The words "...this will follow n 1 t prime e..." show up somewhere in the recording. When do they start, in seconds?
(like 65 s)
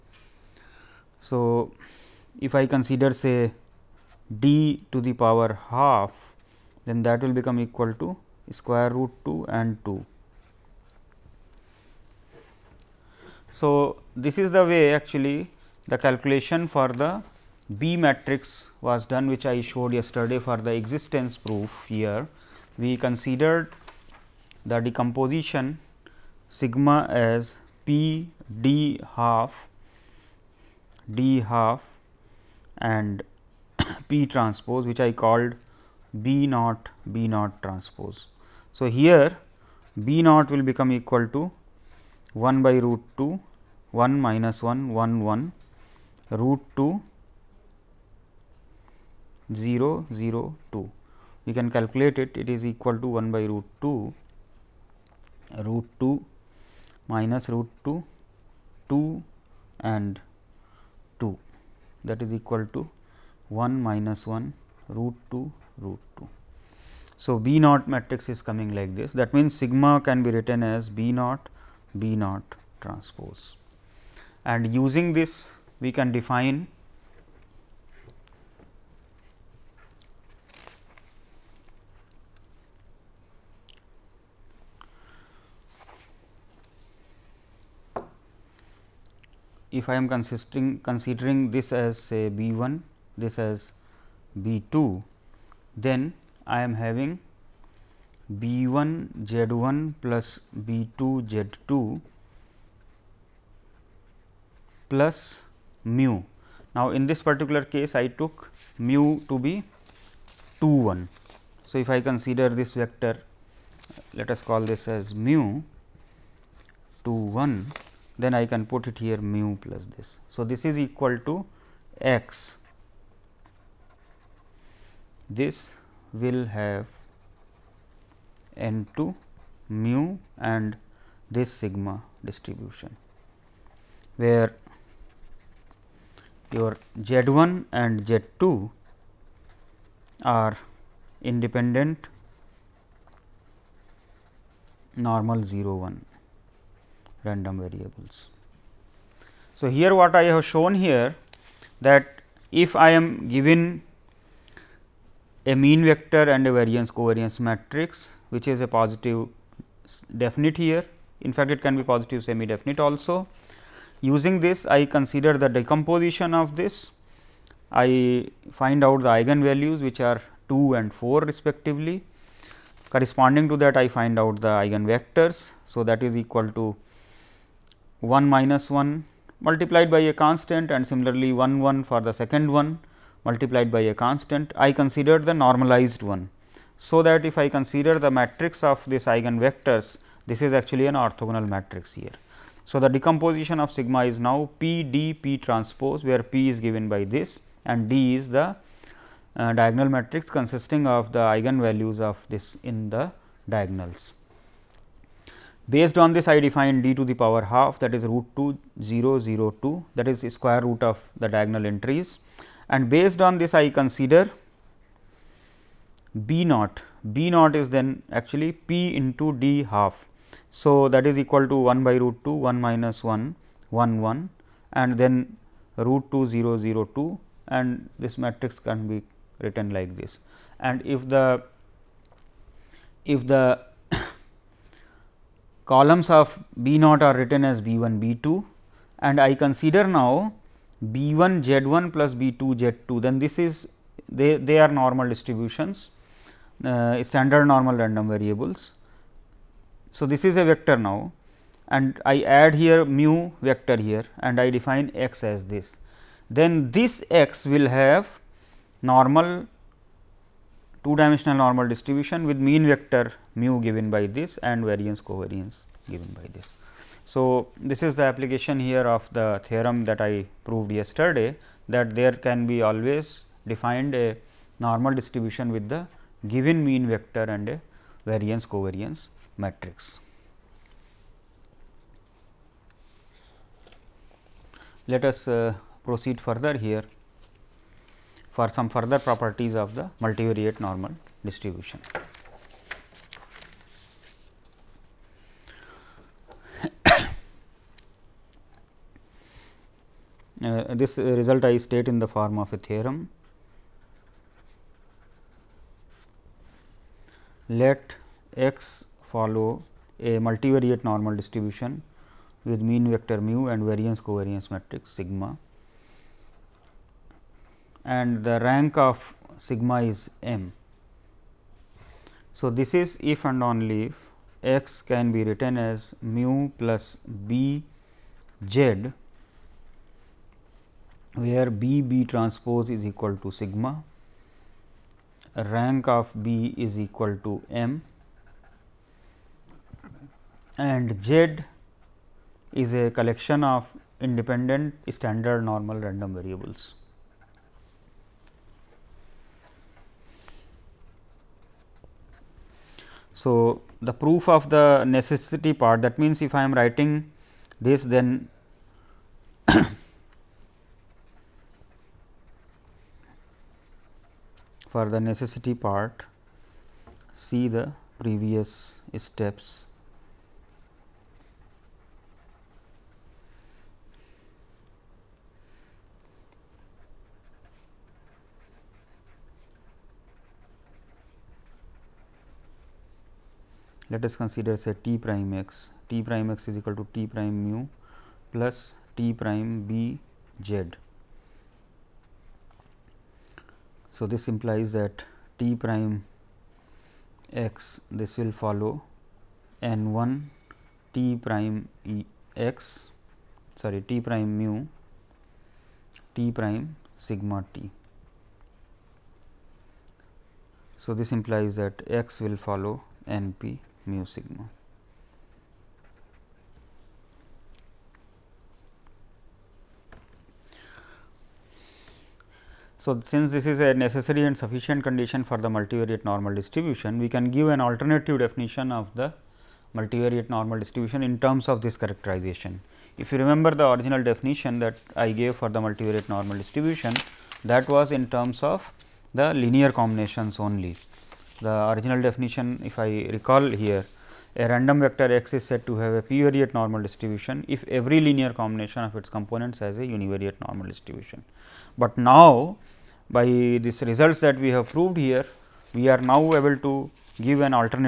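397 s.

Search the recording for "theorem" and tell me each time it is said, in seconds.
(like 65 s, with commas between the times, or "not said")
269 s, 302 s.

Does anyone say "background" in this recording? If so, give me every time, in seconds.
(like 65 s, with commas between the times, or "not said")
not said.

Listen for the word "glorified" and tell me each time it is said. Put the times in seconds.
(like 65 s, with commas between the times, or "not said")
not said.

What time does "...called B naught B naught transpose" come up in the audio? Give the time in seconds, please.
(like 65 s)
35 s.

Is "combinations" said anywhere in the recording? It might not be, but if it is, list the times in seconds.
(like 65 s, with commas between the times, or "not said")
439 s, 448 s.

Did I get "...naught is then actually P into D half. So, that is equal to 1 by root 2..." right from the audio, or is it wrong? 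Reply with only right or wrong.
right.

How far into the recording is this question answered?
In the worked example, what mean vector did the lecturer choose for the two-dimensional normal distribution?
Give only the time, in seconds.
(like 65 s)
108 s.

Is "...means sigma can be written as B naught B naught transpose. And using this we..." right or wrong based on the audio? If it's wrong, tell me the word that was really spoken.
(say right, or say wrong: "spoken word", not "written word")
right.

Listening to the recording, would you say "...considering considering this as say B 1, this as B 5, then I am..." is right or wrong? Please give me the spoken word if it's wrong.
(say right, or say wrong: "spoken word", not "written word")
wrong: "2", not "5".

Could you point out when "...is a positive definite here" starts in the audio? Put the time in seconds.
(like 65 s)
158 s.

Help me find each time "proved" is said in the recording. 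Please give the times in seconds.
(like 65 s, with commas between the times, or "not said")
270 s, 454 s.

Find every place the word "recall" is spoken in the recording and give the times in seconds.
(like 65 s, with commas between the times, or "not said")
443 s.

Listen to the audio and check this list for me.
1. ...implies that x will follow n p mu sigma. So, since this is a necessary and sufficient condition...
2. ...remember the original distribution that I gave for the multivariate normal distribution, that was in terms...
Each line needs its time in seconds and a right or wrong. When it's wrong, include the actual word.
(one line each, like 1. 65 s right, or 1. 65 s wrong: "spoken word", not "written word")
1. 411 s right
2. 433 s wrong: "definition", not "distribution".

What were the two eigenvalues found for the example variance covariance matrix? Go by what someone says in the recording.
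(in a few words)
2 and 4.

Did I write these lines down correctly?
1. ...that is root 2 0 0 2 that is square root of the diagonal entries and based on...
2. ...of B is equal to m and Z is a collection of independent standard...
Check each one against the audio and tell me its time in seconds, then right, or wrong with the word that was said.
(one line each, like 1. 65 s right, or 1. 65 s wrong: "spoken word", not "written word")
1. 207 s right
2. 335 s right.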